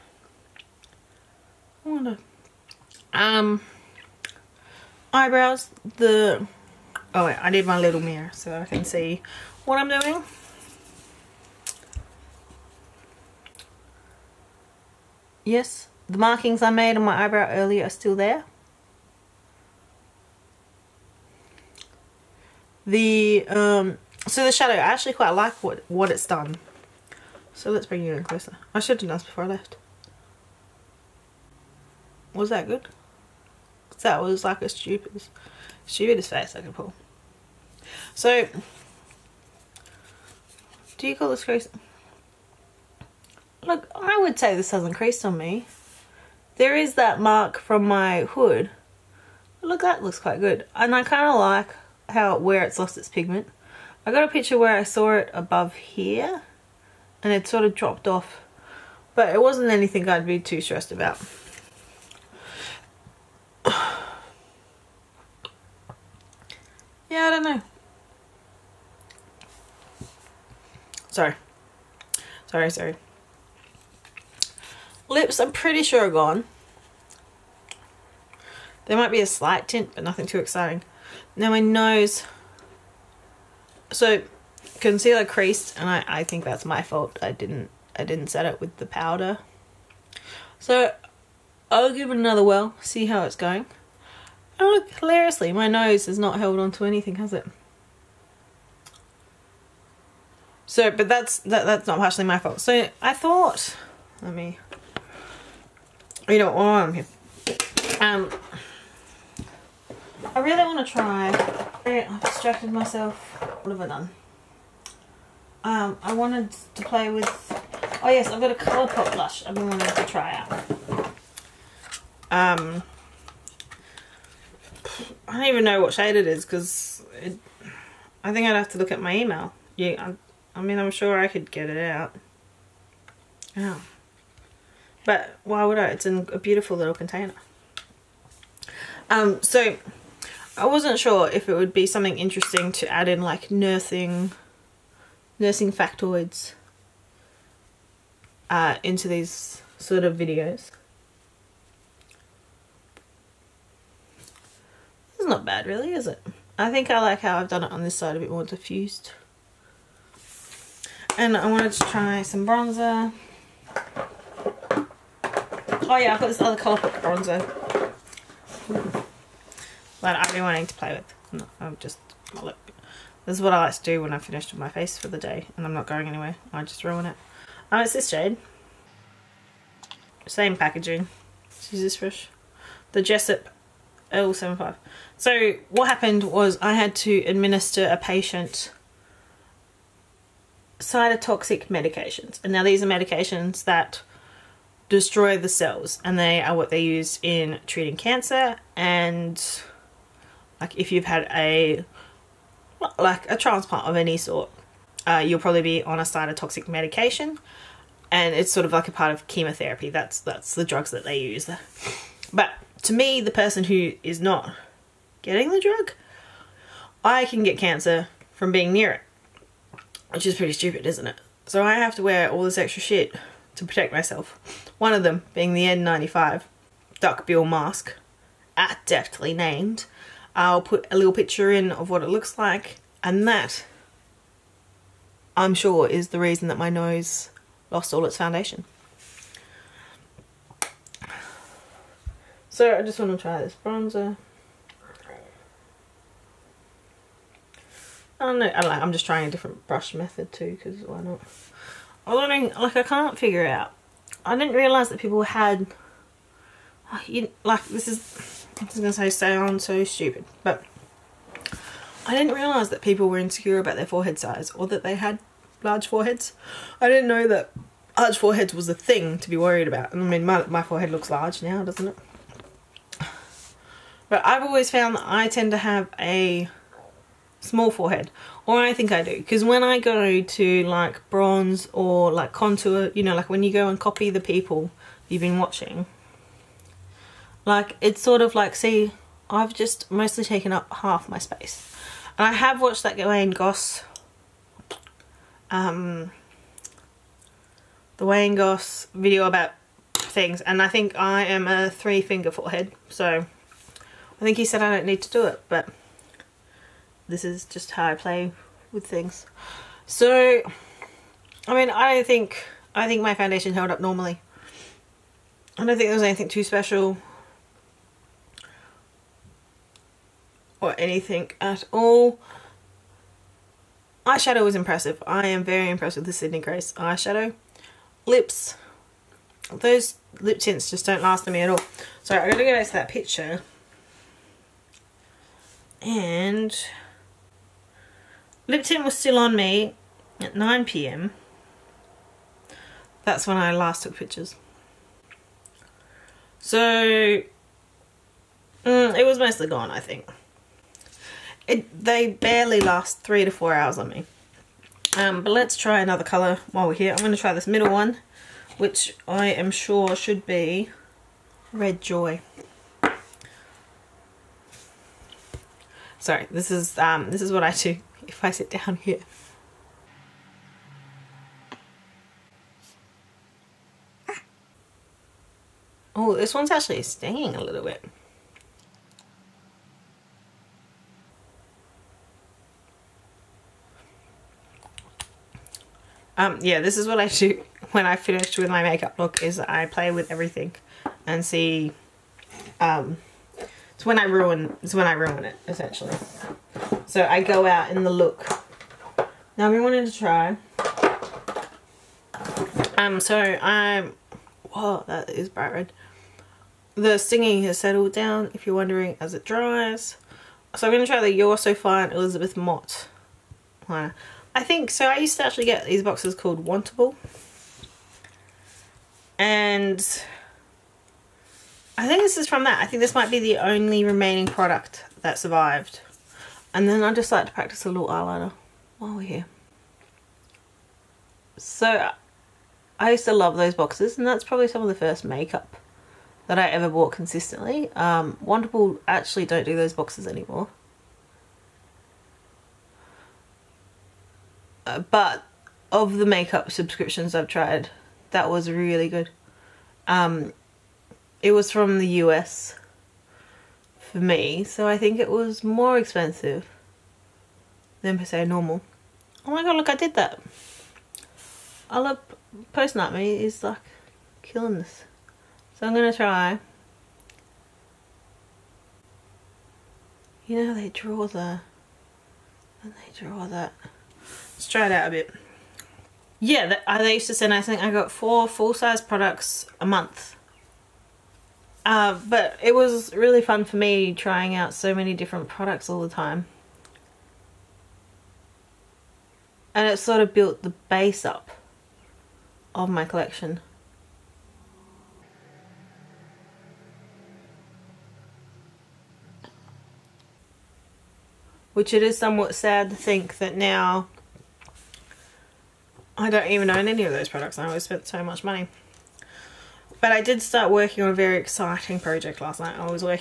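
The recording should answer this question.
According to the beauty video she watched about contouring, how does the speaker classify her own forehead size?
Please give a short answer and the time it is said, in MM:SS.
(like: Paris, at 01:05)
three finger, at 05:01.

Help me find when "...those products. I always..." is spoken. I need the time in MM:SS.
08:26.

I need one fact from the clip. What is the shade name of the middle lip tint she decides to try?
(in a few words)
Red Joy.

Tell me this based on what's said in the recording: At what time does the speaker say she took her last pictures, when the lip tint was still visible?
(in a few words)
9pm.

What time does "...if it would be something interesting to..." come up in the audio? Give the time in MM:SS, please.
02:21.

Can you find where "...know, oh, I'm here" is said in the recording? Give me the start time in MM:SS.
01:46.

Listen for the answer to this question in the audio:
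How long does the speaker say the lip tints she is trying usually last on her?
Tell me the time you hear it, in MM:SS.
05:52.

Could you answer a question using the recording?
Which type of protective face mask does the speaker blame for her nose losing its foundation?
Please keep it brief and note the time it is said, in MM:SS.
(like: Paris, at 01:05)
N95 duckbill, at 03:45.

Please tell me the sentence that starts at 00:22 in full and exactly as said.
The, um, so the shadow, I actually quite like what, what it's done.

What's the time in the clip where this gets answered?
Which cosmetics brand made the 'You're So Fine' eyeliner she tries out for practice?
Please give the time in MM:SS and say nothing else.
06:51.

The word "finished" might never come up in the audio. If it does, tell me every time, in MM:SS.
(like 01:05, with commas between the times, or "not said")
02:54, 06:27.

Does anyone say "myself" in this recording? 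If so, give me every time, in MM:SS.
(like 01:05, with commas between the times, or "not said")
01:52, 03:43.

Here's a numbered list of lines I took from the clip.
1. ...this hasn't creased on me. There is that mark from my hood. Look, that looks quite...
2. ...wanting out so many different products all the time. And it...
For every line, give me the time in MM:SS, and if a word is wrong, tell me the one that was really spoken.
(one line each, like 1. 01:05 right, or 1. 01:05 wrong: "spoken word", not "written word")
1. 00:44 right
2. 08:03 wrong: "trying", not "wanting".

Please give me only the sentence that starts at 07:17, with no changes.
Um, Wantable actually don't do those boxes anymore.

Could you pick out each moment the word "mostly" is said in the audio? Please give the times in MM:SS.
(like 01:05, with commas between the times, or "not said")
04:49, 05:49.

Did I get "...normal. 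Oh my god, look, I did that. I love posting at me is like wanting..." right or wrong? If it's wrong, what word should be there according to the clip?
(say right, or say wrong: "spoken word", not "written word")
wrong: "killing", not "wanting".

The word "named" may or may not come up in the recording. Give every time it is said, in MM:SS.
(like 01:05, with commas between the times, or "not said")
03:49.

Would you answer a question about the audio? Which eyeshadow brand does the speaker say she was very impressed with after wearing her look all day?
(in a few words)
Sydney Grace.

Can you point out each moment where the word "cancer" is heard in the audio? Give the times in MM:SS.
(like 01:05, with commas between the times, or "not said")
03:17, 03:37.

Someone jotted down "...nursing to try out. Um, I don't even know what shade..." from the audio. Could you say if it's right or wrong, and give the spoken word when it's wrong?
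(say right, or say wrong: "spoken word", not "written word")
wrong: "wanting", not "nursing".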